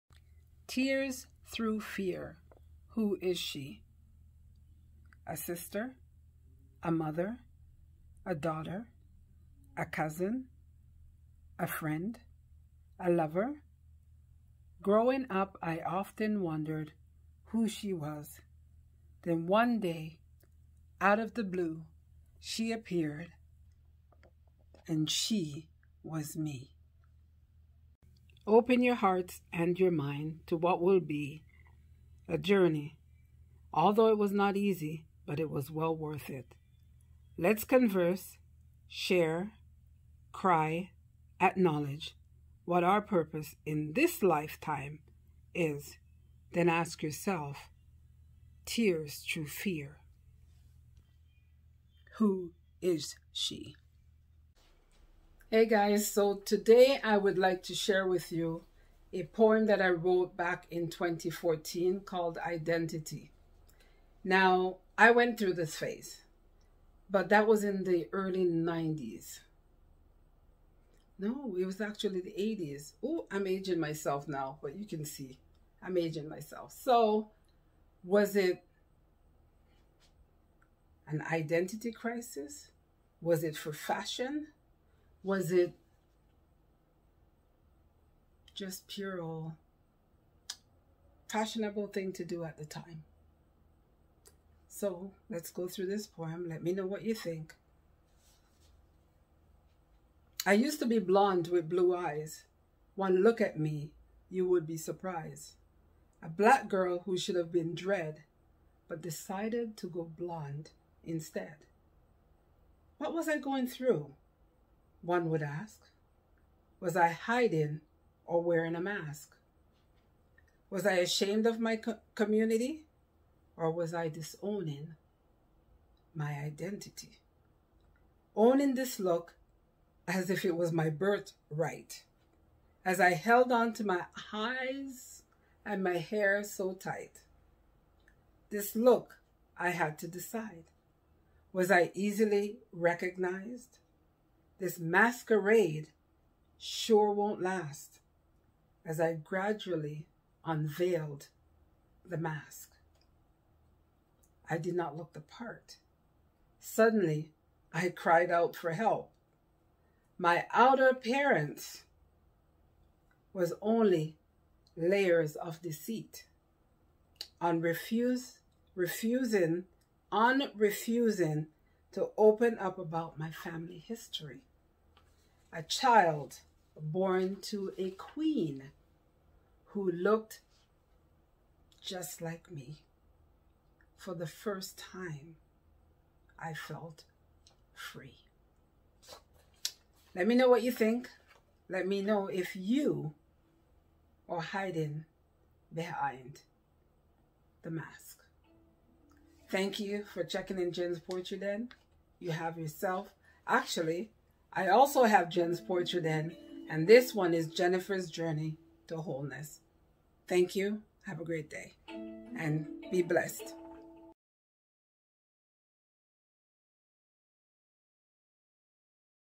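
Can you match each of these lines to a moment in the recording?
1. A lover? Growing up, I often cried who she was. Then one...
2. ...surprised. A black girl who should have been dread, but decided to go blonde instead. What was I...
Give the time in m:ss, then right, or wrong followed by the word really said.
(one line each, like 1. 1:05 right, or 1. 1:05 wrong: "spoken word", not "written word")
1. 0:13 wrong: "wondered", not "cried"
2. 1:44 right.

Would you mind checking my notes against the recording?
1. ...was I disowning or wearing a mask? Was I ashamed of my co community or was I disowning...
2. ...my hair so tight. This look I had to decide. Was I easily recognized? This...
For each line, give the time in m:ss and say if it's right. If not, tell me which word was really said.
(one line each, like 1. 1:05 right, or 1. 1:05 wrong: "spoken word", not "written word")
1. 1:56 wrong: "hiding", not "disowning"
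2. 2:15 right.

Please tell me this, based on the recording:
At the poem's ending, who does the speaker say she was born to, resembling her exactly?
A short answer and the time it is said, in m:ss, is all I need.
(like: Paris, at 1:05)
A queen, at 2:57.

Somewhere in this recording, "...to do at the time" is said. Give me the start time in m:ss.
1:32.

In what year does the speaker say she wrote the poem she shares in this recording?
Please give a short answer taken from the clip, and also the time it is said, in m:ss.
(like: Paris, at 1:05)
2014, at 1:00.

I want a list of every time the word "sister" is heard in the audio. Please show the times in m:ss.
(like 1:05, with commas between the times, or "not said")
0:05.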